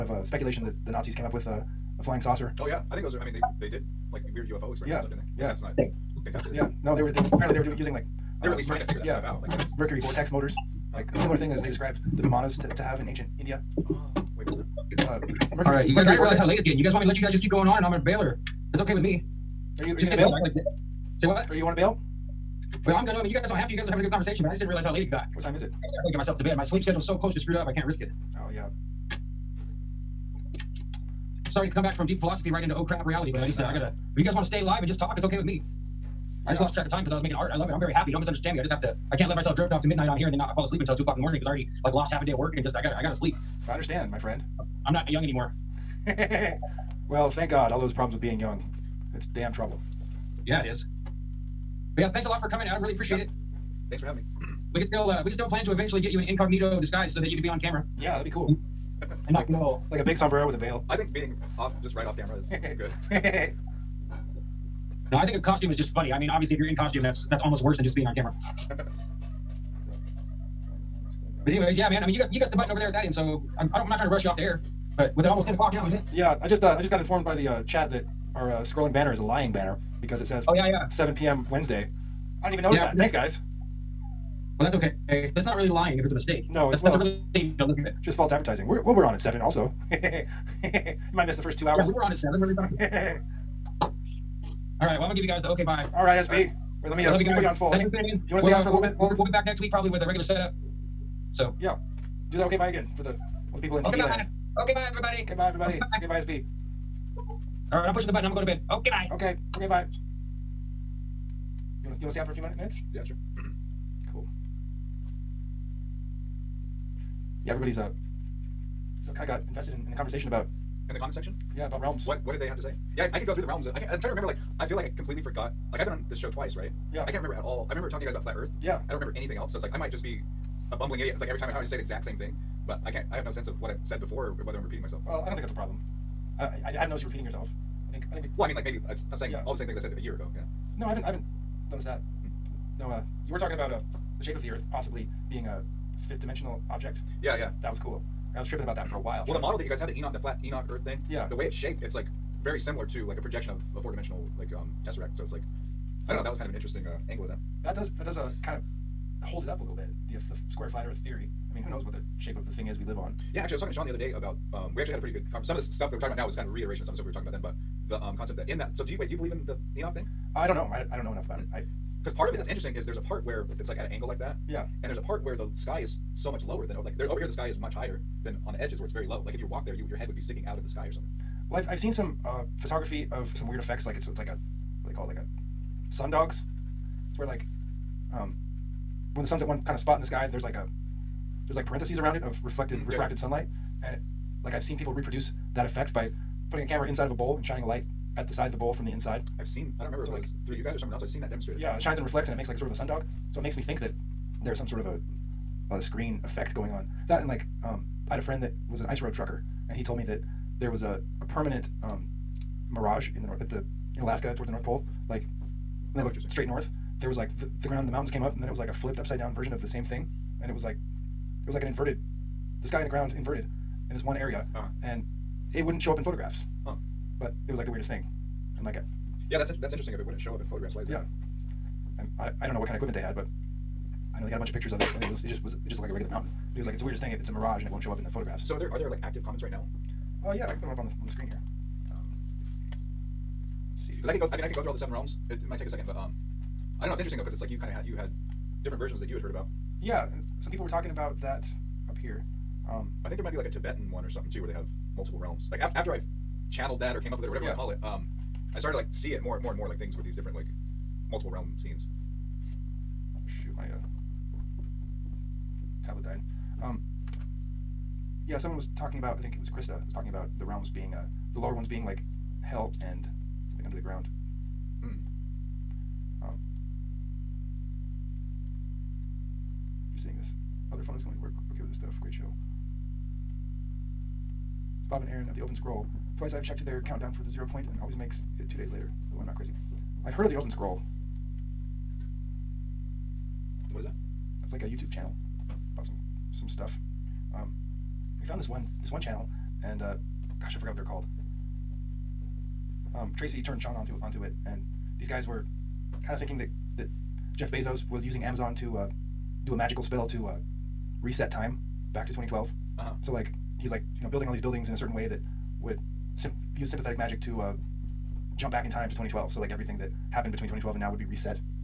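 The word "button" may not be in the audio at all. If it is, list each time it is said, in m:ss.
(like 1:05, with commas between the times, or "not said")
1:12, 1:48.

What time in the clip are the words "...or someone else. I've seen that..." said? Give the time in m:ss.
3:20.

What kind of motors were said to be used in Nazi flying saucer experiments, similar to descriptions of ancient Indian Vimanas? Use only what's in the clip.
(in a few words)
Mercury vortex motors.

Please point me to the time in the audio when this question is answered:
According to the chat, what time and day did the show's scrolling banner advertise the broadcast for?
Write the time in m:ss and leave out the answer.
1:20.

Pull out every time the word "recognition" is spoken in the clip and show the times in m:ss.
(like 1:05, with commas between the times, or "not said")
not said.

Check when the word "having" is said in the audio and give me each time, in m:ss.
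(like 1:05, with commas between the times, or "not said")
0:23, 0:54.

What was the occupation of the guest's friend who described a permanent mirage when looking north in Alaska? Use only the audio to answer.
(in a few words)
ice road trucker.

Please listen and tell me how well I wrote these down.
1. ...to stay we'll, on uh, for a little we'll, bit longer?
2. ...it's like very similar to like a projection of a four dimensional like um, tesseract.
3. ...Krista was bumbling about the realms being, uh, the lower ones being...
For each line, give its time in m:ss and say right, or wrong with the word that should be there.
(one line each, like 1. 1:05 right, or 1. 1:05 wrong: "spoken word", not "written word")
1. 1:38 right
2. 2:31 right
3. 4:29 wrong: "talking", not "bumbling".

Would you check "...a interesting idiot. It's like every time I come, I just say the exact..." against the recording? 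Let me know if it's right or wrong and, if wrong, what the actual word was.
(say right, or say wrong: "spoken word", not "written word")
wrong: "bumbling", not "interesting".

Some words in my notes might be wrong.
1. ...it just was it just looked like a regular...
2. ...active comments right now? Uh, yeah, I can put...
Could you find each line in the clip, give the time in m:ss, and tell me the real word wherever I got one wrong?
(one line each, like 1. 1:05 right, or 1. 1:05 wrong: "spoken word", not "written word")
1. 3:55 right
2. 3:59 right.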